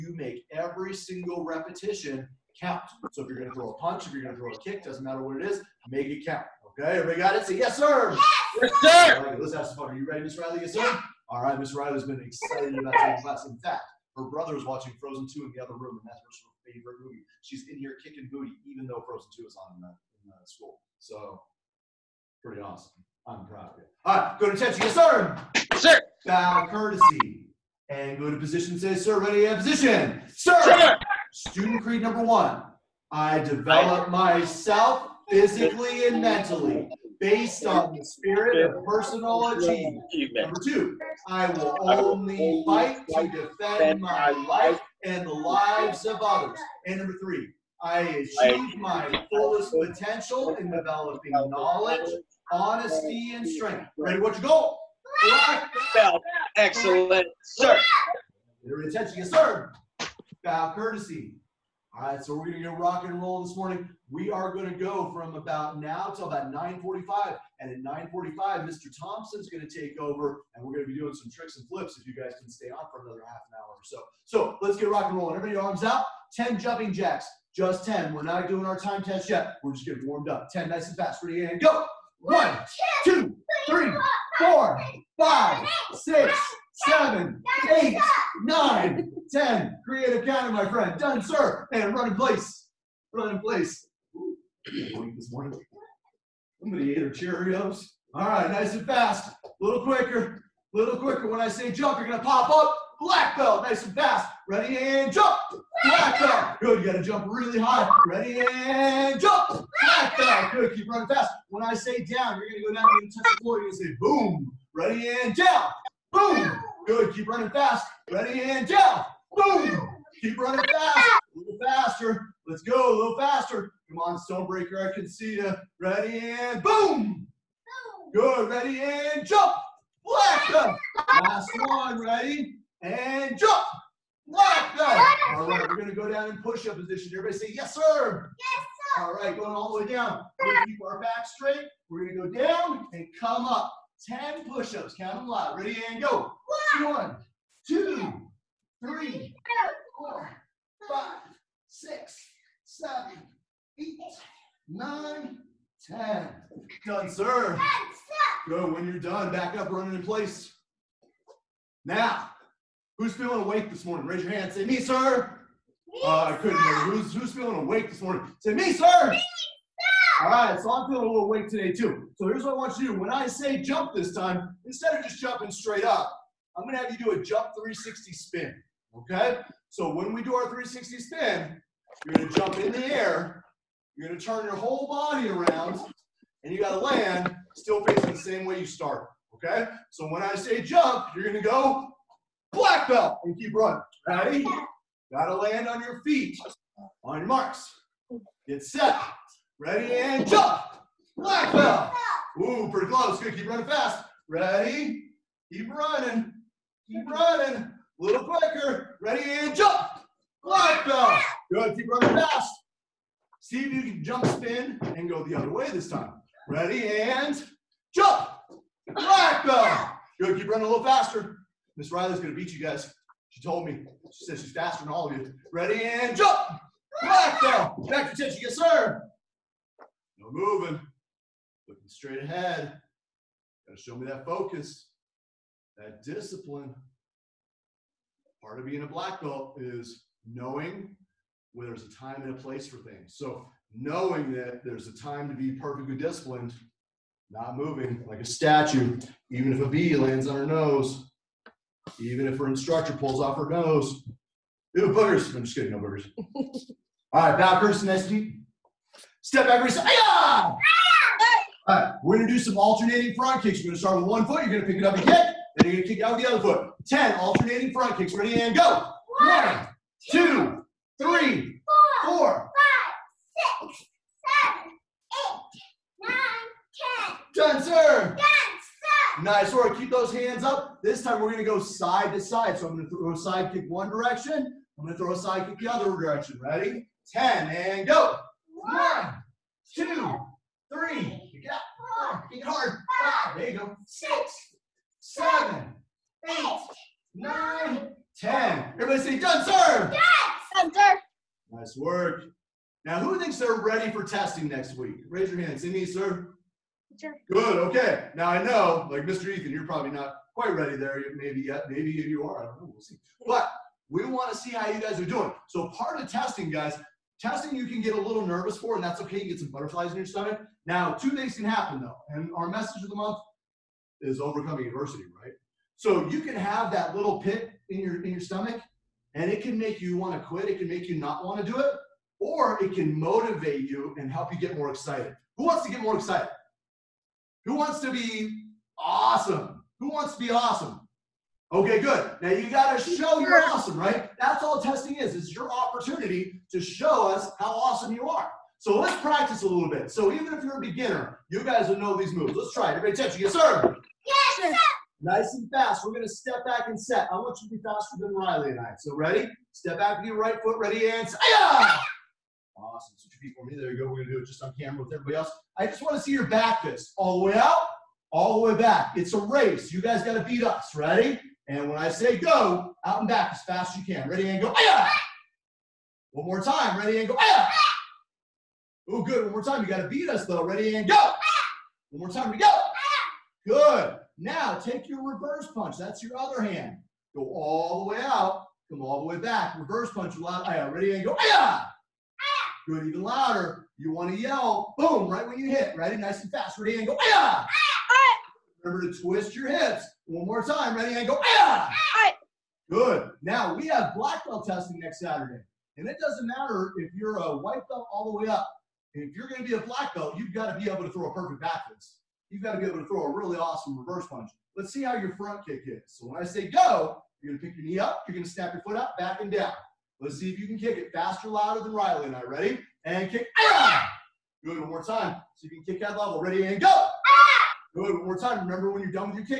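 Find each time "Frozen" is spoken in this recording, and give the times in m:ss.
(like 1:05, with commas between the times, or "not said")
0:15, 0:19.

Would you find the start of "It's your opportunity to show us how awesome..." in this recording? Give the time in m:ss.
5:45.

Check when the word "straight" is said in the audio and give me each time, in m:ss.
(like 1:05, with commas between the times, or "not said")
2:21, 2:55, 3:51.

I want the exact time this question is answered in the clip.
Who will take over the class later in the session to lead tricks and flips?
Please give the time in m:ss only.
1:08.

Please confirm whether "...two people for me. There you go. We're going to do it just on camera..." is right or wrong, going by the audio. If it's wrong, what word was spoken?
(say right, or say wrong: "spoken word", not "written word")
right.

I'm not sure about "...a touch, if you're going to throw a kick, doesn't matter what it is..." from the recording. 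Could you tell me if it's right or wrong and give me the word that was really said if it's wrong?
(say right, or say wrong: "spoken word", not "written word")
wrong: "punch", not "touch".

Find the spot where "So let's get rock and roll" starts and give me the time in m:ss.
1:14.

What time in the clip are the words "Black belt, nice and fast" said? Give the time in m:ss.
1:43.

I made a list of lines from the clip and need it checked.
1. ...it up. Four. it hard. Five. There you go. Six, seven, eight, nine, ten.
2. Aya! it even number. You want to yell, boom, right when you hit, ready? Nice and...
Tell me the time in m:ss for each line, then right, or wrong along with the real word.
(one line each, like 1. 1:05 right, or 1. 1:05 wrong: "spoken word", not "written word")
1. 4:51 right
2. 6:31 wrong: "louder", not "number".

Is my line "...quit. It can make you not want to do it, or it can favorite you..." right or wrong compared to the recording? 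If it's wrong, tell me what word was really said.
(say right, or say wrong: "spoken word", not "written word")
wrong: "motivate", not "favorite".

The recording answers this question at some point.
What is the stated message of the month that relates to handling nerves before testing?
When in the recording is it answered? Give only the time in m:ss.
5:24.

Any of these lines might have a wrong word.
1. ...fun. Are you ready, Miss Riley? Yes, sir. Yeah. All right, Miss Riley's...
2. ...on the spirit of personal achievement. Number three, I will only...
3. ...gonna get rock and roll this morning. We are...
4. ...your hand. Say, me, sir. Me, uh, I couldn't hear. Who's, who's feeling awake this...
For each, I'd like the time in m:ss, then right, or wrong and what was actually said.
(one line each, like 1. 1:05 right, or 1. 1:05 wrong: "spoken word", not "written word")
1. 0:09 right
2. 0:37 wrong: "two", not "three"
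3. 1:02 right
4. 2:44 right.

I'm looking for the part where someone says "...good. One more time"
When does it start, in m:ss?
6:19.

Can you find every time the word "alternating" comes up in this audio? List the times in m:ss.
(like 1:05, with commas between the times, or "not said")
4:22, 4:27.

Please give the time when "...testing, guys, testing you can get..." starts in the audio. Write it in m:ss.
5:16.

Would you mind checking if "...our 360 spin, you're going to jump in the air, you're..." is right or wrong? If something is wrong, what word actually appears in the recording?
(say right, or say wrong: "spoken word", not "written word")
right.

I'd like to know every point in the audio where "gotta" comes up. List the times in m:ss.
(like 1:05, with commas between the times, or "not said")
1:46, 3:15, 3:53.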